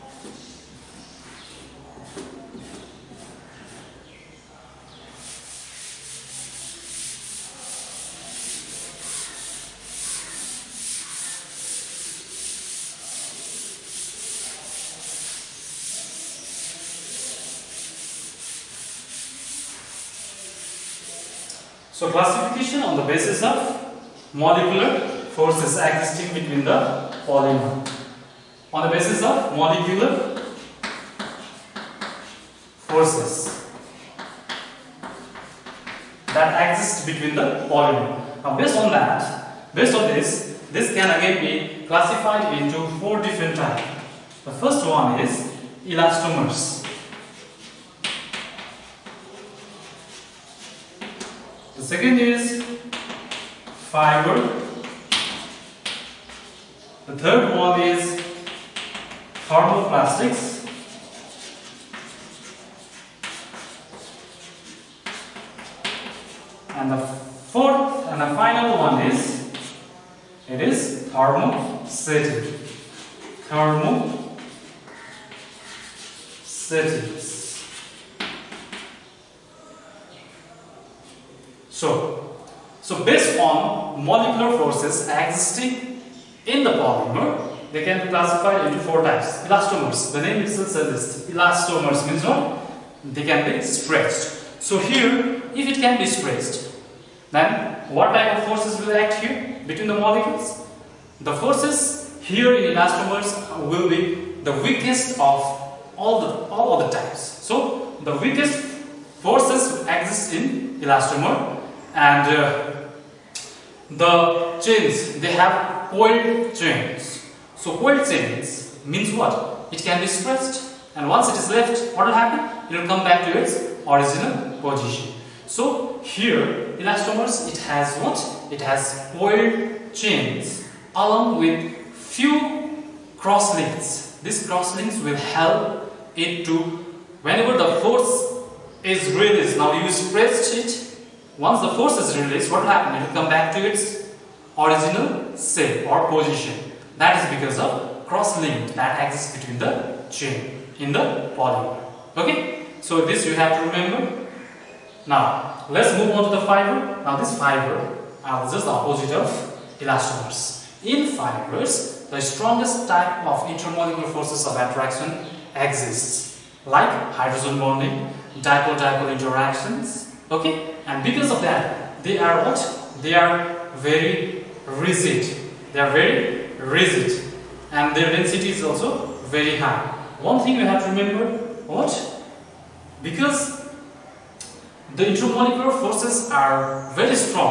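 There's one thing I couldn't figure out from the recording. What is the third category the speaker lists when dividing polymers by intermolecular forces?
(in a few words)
Thermoplastics.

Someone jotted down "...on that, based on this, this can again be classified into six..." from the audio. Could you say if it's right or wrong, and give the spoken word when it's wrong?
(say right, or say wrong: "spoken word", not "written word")
wrong: "four", not "six".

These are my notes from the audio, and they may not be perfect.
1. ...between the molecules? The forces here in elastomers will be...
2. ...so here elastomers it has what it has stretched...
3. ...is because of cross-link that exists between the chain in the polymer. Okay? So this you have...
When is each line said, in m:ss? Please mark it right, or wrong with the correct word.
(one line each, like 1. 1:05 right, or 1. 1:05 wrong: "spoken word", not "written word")
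1. 1:39 right
2. 2:05 wrong: "coiled", not "stretched"
3. 2:27 right.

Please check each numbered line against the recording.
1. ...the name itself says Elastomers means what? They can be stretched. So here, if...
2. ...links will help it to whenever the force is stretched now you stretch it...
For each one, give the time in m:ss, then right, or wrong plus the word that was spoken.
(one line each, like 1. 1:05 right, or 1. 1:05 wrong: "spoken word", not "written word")
1. 1:30 right
2. 2:14 wrong: "released", not "stretched".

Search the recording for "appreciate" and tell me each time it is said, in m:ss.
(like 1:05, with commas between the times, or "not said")
not said.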